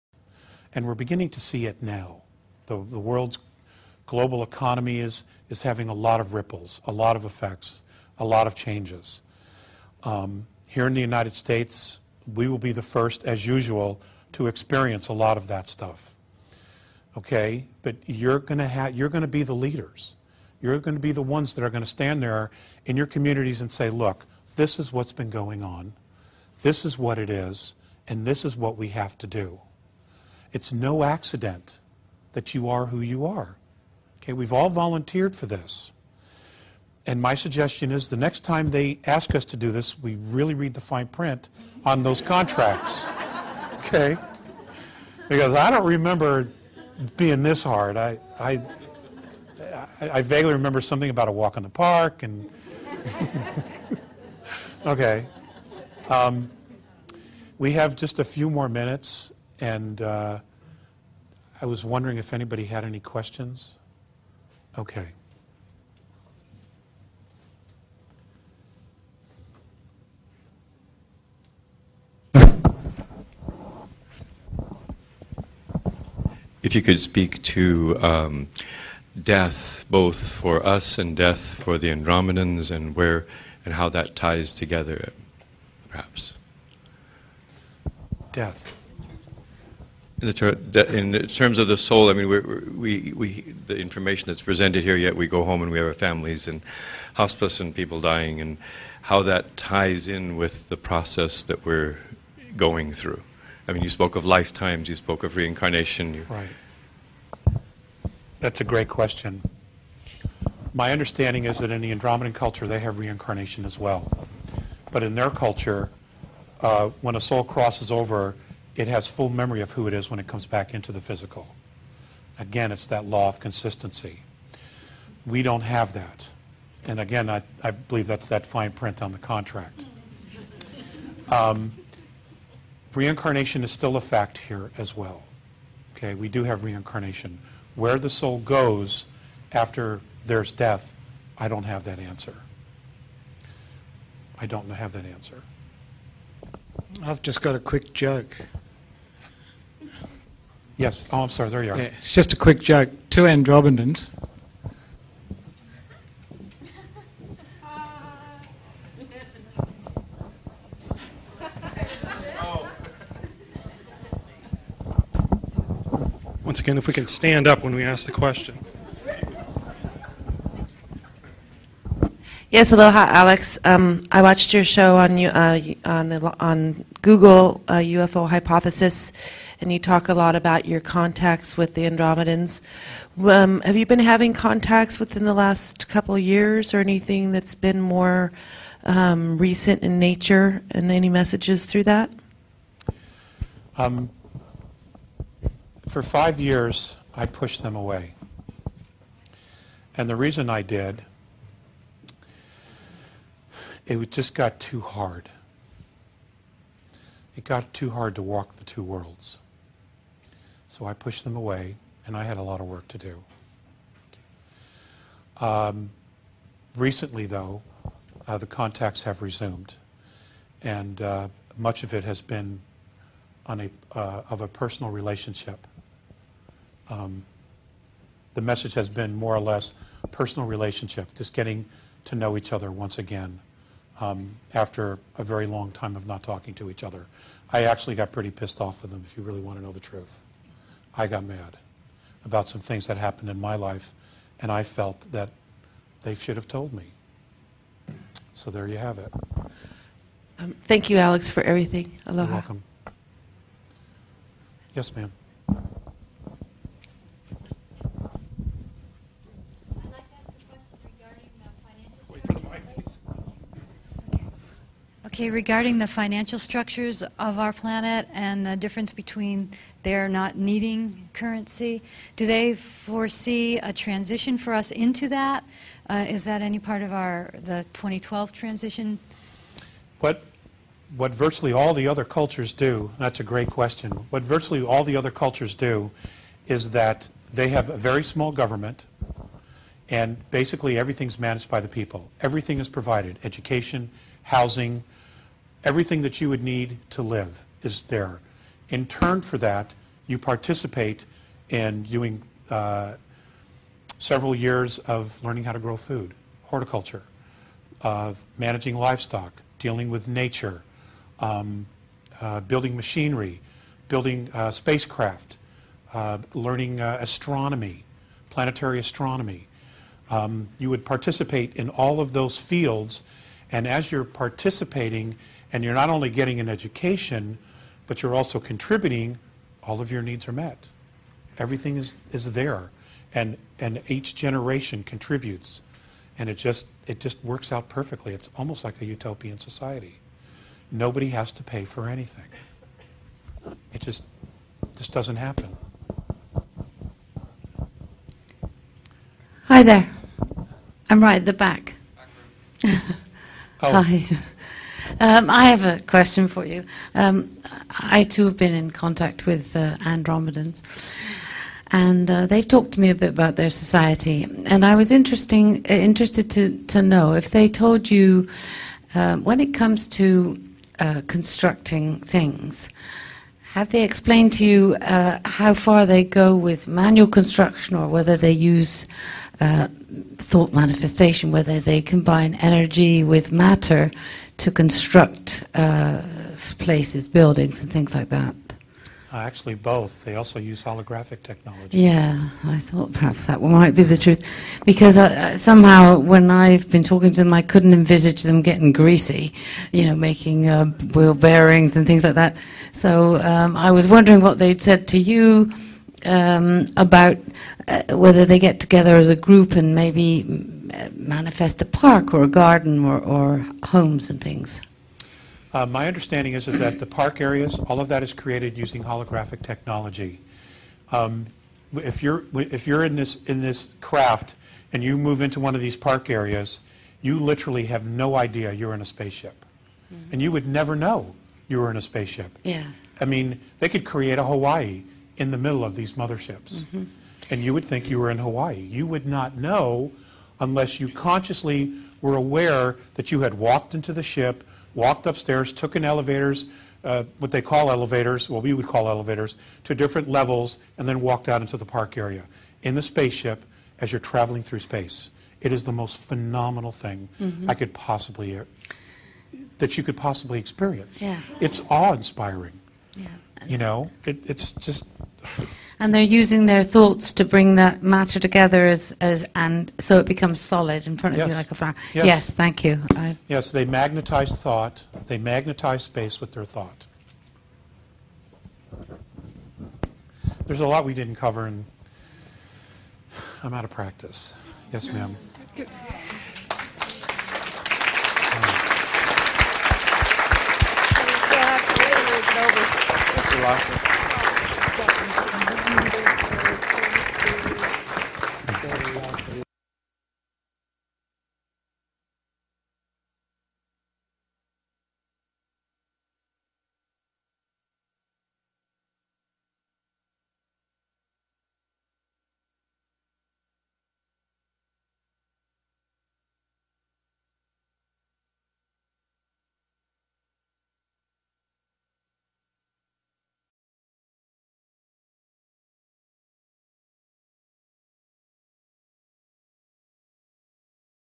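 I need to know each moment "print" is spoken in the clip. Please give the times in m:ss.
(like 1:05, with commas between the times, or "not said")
0:41, 2:08.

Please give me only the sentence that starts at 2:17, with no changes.
Where the soul goes after there's death, I don't have that answer.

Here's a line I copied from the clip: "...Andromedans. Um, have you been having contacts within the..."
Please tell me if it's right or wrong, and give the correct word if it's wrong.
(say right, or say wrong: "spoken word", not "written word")
right.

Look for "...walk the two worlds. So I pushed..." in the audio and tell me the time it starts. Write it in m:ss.
3:28.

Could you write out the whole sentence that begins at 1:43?
I mean, you spoke of lifetimes, you spoke of reincarnation.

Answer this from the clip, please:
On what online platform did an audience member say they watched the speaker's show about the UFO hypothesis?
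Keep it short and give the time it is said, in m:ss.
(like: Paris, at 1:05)
Google, at 2:57.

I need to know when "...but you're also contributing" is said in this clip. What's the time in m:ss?
5:27.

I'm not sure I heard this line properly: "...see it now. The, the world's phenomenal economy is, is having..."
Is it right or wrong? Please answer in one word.
wrong.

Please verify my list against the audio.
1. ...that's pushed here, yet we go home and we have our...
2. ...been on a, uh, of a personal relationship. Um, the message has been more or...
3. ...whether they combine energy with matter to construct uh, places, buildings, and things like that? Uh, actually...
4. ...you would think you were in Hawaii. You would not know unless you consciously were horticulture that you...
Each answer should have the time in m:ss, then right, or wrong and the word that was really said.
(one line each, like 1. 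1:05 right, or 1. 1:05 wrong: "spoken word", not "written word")
1. 1:34 wrong: "presented", not "pushed"
2. 3:42 right
3. 6:21 right
4. 7:17 wrong: "aware", not "horticulture".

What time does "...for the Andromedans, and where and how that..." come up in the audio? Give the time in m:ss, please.
1:21.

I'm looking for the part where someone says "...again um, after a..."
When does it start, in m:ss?
3:52.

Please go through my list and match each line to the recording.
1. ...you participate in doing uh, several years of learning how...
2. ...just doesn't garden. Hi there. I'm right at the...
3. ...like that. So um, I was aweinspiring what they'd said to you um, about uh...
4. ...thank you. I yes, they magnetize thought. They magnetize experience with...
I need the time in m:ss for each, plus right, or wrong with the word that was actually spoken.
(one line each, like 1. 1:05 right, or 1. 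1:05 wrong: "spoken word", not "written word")
1. 5:00 right
2. 5:44 wrong: "happen", not "garden"
3. 6:42 wrong: "wondering", not "aweinspiring"
4. 7:52 wrong: "space", not "experience".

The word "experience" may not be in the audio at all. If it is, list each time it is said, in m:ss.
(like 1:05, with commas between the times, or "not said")
0:14, 7:40.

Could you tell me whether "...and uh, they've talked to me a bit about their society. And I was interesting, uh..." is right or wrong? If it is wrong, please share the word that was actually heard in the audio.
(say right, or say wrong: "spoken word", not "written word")
right.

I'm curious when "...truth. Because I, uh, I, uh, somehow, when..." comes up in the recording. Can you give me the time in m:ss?
6:33.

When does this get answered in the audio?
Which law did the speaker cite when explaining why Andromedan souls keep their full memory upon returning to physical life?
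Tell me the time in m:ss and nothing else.
2:03.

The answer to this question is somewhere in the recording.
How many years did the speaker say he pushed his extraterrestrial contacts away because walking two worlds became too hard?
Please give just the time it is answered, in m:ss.
3:16.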